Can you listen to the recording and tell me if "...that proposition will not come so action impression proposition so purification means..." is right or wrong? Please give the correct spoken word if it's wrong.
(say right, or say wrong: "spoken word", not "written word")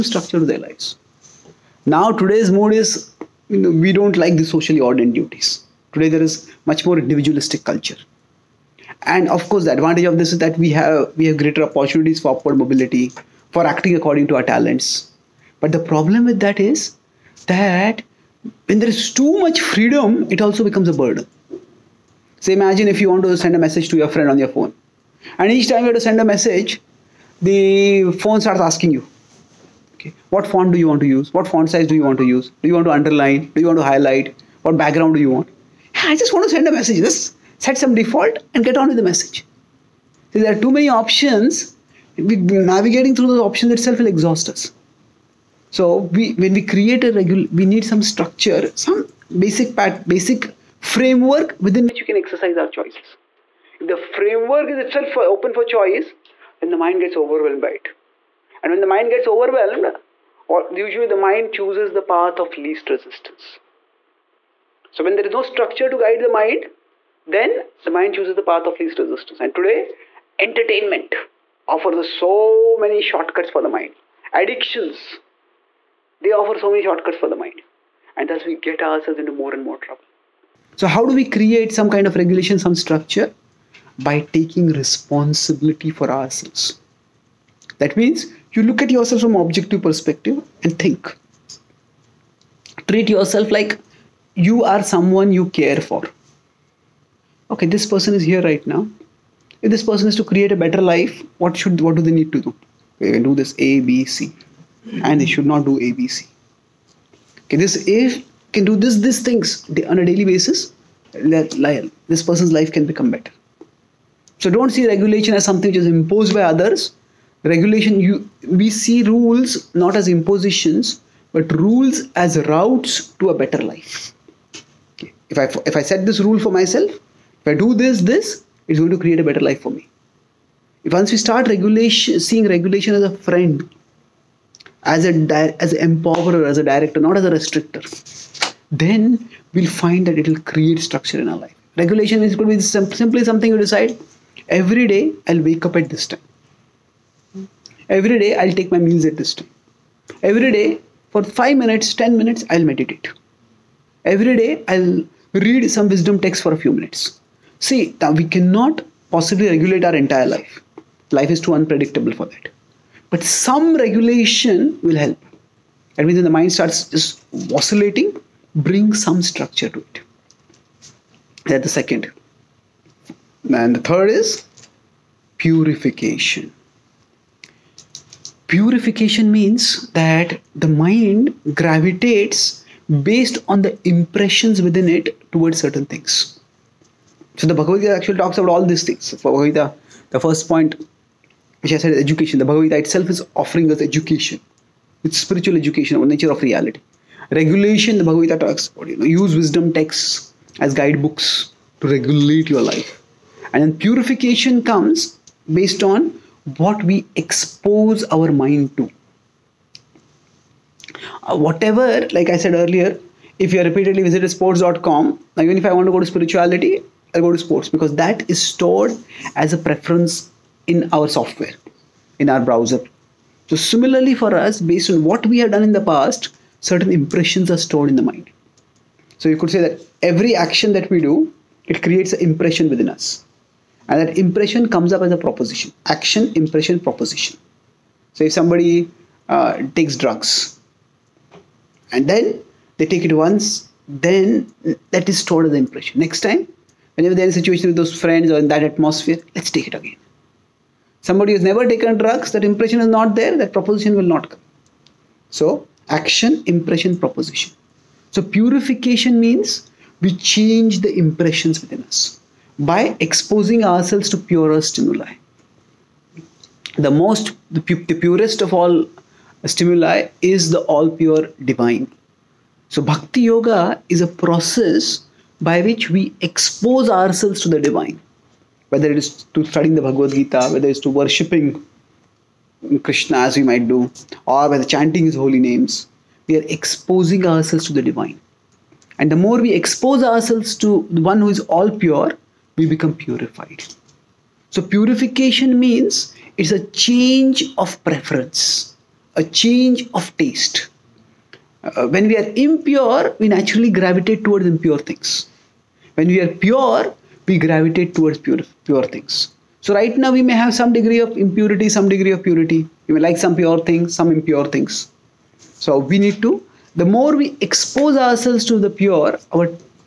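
right.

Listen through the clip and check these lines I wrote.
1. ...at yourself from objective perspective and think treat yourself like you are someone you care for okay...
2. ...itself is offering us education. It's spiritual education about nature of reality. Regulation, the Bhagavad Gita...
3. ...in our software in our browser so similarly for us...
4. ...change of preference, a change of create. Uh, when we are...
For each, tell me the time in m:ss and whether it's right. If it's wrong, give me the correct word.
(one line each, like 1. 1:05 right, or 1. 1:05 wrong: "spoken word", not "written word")
1. 1:28 right
2. 3:12 right
3. 3:40 right
4. 4:56 wrong: "taste", not "create".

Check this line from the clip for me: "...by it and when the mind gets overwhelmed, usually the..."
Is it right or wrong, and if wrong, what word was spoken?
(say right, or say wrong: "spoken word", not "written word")
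right.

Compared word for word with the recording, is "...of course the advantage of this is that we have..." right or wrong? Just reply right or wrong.
right.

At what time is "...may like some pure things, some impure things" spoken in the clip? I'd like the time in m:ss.
5:12.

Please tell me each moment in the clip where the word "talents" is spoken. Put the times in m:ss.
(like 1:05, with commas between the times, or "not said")
0:14.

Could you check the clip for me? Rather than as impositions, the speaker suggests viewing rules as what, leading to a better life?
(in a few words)
Routes.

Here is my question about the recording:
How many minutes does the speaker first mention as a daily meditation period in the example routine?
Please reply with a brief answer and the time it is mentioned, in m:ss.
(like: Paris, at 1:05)
5, at 2:31.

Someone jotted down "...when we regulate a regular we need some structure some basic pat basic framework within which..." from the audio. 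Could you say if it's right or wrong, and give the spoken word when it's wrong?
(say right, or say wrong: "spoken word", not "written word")
wrong: "create", not "regulate".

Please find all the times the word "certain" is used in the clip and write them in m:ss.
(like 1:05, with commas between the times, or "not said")
3:05, 3:46.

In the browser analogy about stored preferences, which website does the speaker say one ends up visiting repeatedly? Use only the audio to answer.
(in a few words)
sports.com.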